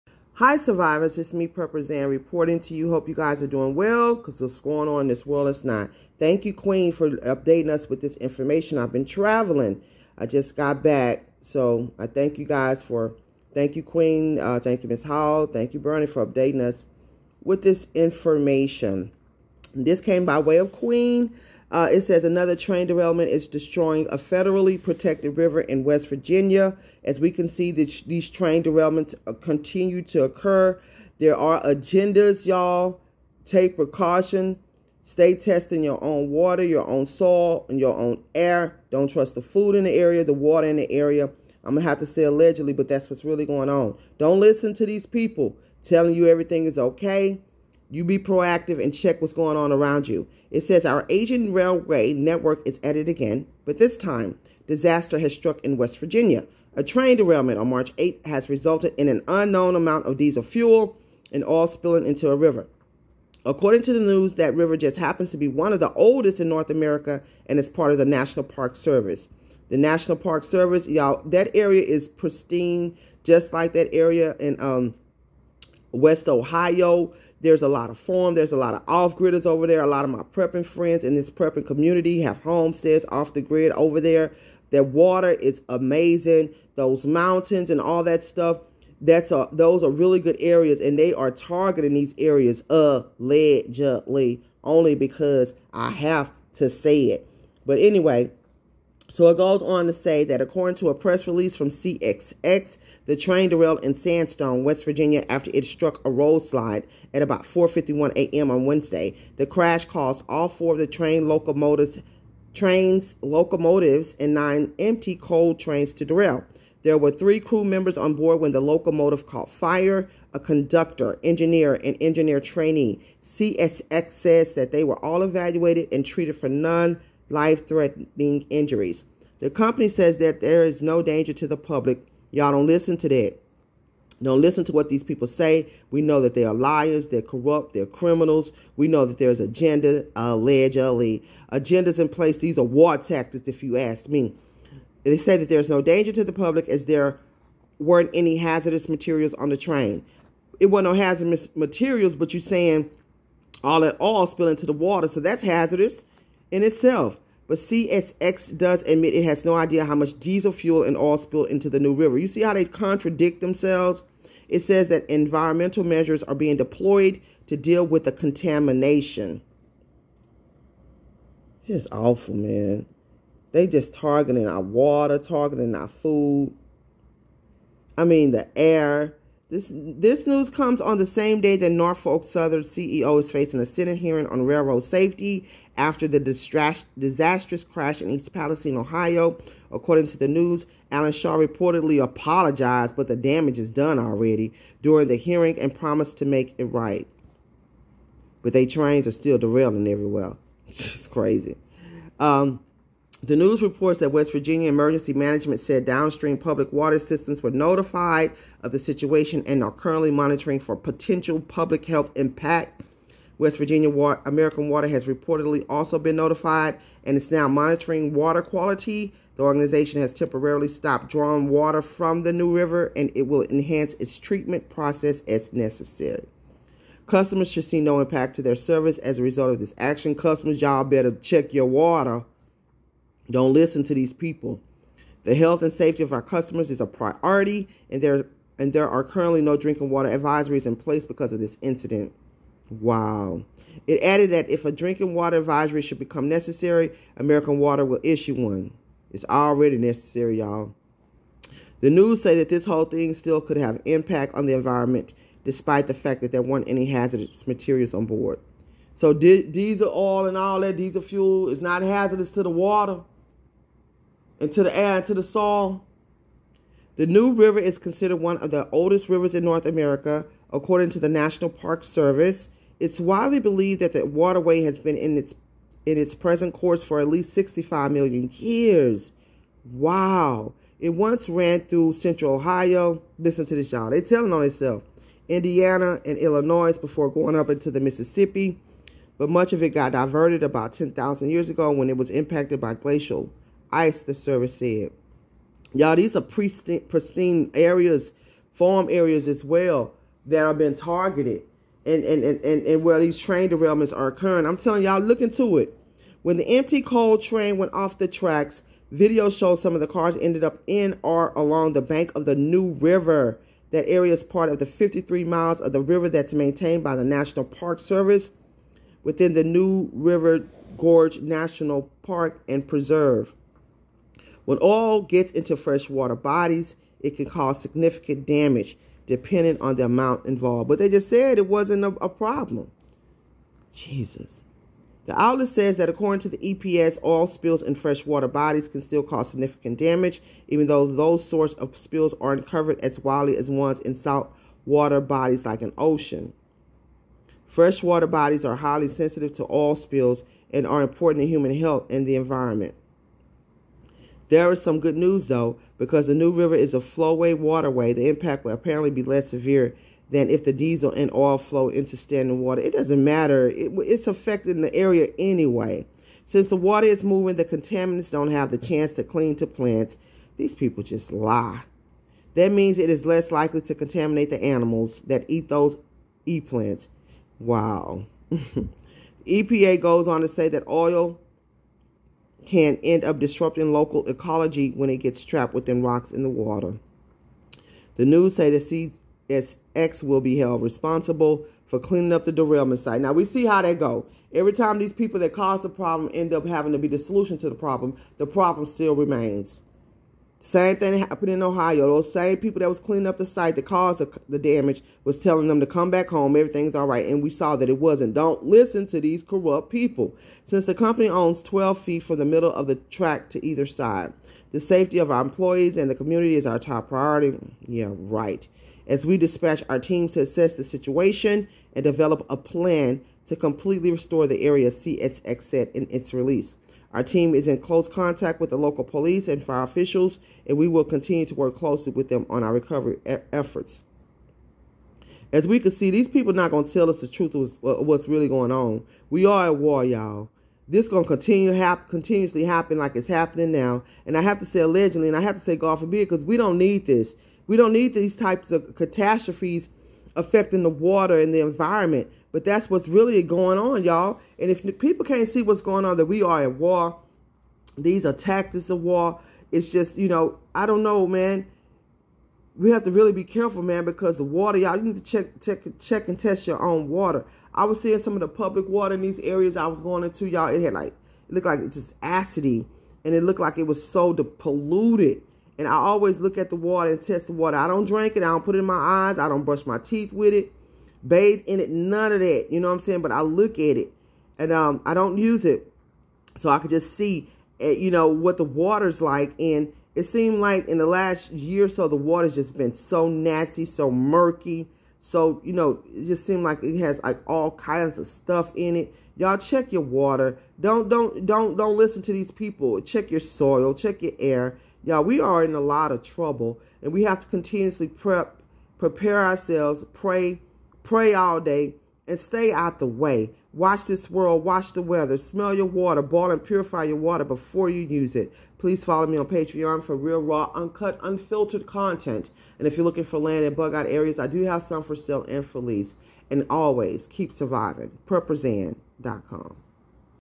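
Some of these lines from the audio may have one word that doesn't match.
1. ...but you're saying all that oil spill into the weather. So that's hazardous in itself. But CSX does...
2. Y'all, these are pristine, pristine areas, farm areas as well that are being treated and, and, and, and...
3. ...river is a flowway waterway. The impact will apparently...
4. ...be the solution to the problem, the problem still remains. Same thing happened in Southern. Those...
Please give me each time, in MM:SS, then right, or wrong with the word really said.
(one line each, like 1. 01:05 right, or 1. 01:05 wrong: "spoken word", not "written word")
1. 02:32 wrong: "water", not "weather"
2. 04:55 wrong: "targeted", not "treated"
3. 05:56 right
4. 06:36 wrong: "Ohio", not "Southern".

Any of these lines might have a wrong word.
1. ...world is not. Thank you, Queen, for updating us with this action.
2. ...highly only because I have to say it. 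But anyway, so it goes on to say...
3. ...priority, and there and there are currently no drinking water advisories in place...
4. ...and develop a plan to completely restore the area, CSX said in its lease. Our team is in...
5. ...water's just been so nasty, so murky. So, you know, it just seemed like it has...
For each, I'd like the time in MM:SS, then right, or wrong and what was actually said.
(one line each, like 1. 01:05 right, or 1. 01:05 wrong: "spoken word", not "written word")
1. 00:05 wrong: "information", not "action"
2. 01:32 wrong: "allegedly", not "highly"
3. 03:56 right
4. 07:01 wrong: "release", not "lease"
5. 08:11 right.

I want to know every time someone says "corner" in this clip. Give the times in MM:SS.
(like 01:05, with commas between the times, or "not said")
not said.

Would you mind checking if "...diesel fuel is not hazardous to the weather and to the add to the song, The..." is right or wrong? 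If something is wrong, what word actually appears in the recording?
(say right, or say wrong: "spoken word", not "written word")
wrong: "water", not "weather".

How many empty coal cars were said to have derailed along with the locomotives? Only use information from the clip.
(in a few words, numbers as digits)
9.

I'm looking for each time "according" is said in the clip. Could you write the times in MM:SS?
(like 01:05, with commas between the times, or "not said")
01:03, 01:40, 03:09, 04:30, 05:35.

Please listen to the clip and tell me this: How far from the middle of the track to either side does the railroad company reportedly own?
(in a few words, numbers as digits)
12 feet.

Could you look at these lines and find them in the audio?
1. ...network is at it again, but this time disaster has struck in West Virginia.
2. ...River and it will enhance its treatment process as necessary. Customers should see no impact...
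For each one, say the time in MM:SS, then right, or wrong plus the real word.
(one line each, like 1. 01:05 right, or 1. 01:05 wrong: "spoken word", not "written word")
1. 00:52 right
2. 03:42 right.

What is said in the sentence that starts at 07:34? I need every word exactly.
And if people can't see what's going on, that we are at war, these are tactics of war.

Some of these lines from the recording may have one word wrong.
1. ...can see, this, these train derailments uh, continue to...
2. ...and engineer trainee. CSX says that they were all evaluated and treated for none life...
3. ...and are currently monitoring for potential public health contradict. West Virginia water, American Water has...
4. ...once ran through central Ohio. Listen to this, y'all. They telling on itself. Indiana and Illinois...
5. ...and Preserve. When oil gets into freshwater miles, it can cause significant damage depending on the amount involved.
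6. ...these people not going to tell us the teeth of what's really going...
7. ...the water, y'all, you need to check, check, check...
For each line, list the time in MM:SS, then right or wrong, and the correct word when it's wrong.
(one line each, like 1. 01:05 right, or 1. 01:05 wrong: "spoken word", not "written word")
1. 00:27 right
2. 02:01 right
3. 03:29 wrong: "impact", not "contradict"
4. 04:40 right
5. 05:22 wrong: "bodies", not "miles"
6. 07:15 wrong: "truth", not "teeth"
7. 07:44 right.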